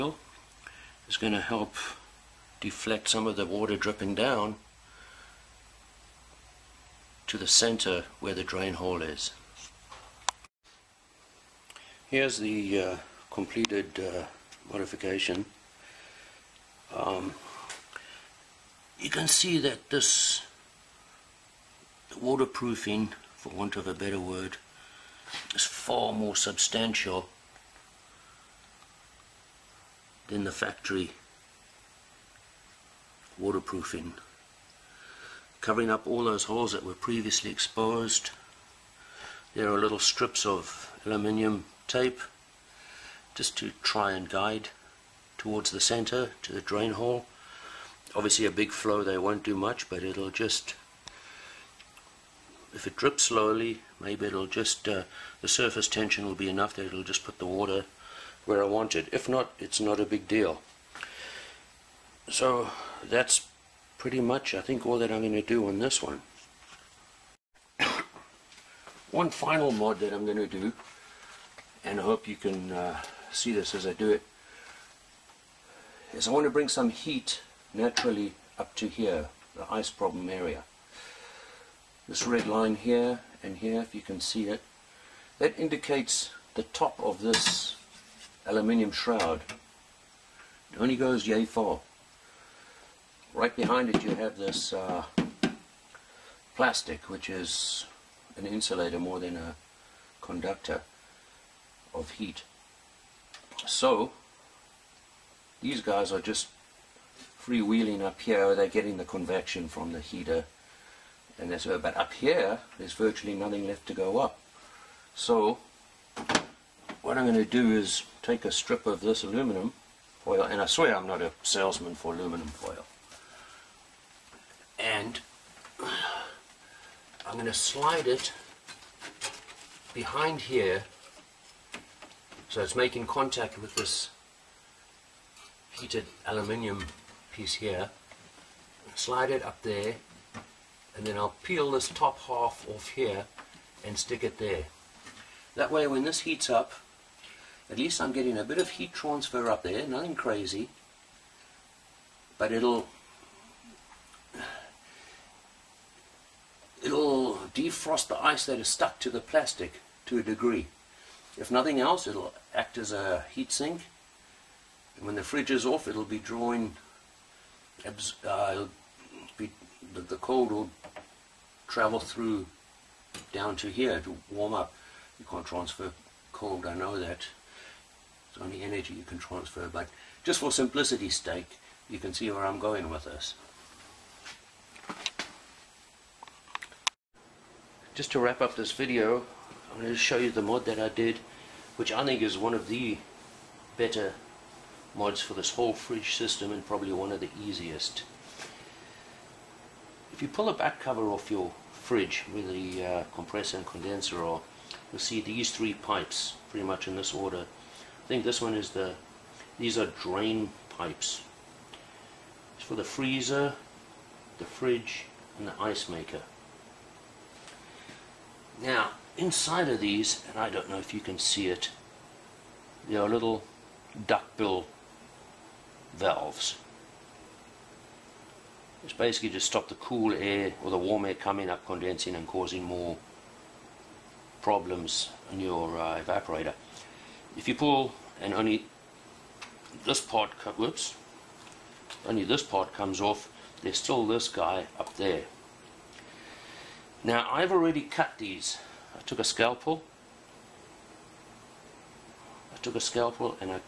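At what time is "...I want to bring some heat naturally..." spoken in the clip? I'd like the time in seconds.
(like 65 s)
76 s.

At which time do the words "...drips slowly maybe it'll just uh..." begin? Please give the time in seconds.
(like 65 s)
52 s.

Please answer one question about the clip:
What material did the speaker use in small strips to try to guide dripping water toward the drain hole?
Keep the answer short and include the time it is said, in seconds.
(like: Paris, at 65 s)
aluminium tape, at 41 s.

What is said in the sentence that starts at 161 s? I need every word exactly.
If nothing else, it'll act as a heat sink.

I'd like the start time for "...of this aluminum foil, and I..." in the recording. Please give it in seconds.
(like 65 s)
118 s.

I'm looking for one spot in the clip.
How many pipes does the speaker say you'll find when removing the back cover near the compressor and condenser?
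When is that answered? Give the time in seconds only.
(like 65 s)
205 s.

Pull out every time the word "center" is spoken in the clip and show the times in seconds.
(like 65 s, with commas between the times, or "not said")
7 s, 45 s.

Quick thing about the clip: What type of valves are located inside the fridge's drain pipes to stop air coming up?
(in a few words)
duckbill valves.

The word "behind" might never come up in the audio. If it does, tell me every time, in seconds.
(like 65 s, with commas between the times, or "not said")
93 s, 129 s.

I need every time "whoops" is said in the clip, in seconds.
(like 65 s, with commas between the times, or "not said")
240 s.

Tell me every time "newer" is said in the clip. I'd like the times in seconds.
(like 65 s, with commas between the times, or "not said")
not said.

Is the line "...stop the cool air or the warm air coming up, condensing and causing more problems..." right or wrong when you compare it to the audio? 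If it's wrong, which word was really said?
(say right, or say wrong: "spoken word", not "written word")
right.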